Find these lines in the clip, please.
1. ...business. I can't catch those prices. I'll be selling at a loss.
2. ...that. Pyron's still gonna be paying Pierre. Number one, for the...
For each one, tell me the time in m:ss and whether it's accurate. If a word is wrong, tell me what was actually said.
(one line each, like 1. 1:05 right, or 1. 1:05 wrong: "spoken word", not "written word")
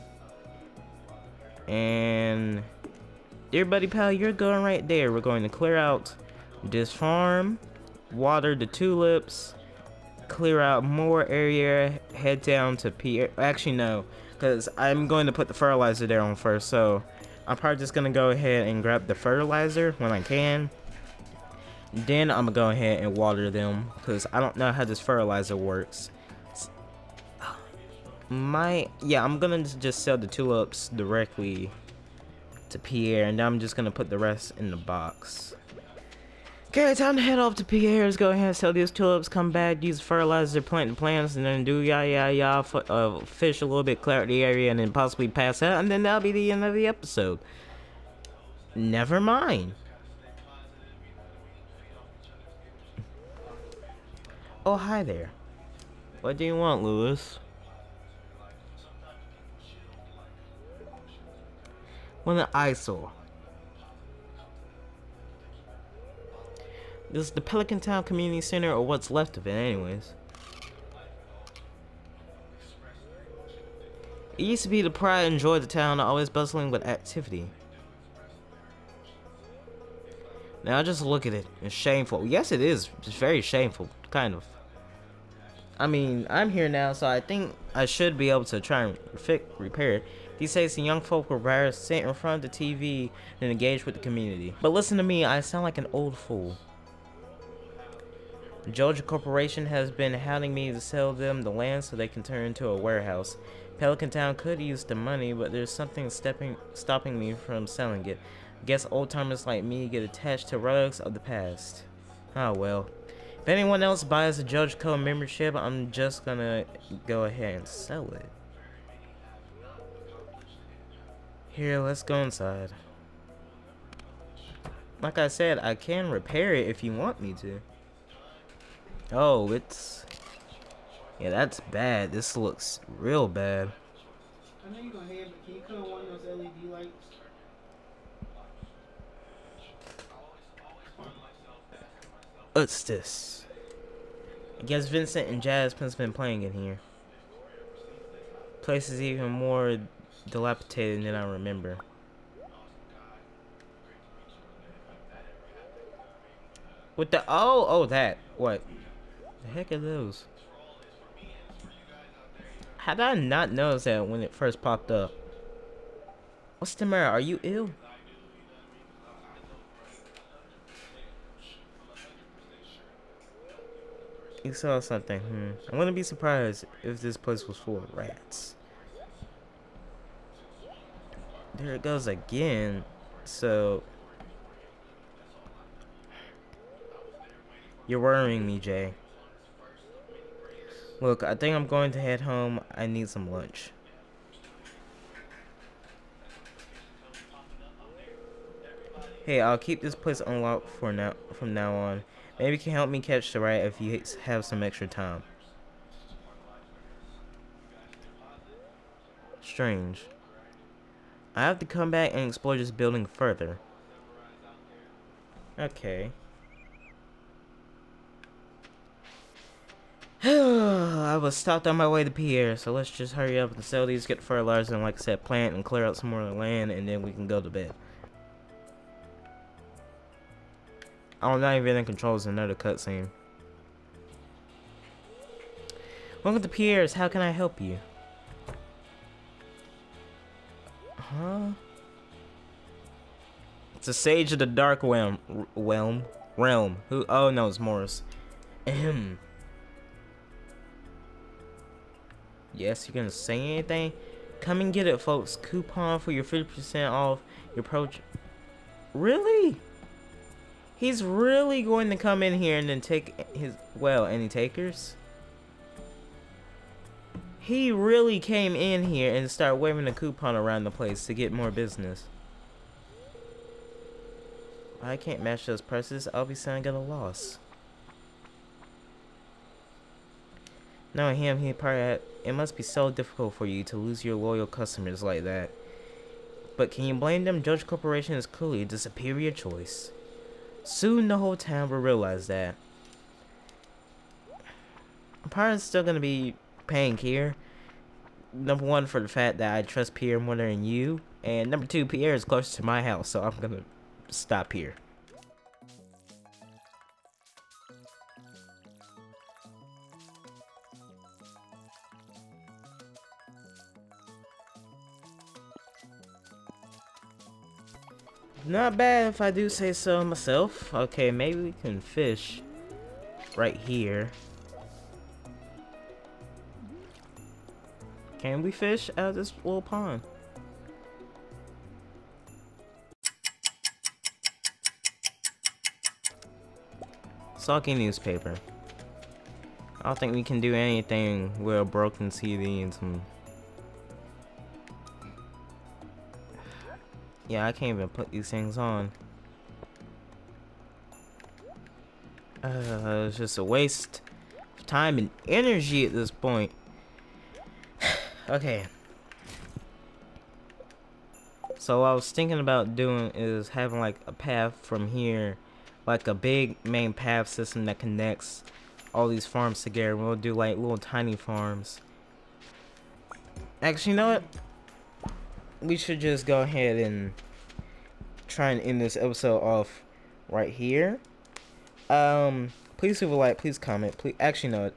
1. 4:31 wrong: "match", not "catch"
2. 4:52 right.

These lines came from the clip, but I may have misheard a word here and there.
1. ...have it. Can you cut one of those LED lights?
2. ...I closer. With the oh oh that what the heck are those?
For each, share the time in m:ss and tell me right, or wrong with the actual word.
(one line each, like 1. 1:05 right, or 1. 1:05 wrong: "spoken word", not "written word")
1. 2:15 right
2. 2:31 wrong: "remember", not "closer".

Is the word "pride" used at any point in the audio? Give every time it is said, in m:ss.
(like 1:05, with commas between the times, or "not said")
1:14.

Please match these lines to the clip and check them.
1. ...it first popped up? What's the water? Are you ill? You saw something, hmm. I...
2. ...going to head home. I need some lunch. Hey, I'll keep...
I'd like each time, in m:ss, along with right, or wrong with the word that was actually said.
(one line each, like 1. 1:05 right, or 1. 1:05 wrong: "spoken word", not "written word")
1. 2:44 wrong: "matter", not "water"
2. 3:11 right.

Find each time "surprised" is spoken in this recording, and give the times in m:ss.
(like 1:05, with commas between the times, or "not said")
2:56.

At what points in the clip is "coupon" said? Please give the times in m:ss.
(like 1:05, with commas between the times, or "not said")
4:15, 4:29.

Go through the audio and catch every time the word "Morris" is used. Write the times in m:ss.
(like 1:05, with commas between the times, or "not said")
4:07.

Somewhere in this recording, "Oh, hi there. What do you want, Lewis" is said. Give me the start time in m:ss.
0:54.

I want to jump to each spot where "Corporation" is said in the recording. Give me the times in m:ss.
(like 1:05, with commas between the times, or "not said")
1:39, 4:47.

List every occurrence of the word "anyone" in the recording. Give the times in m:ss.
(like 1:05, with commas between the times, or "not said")
1:53.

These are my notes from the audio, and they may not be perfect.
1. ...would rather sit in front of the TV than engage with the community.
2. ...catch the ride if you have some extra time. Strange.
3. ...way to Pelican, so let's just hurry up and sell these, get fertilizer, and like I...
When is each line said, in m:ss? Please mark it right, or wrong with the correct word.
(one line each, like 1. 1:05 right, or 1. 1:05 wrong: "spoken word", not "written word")
1. 1:31 right
2. 3:22 right
3. 3:41 wrong: "Pierre", not "Pelican".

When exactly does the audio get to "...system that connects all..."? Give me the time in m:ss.
6:07.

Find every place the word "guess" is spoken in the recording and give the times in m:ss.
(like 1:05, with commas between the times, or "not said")
1:48, 2:24.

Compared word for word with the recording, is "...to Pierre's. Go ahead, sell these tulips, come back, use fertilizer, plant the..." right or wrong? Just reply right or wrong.
right.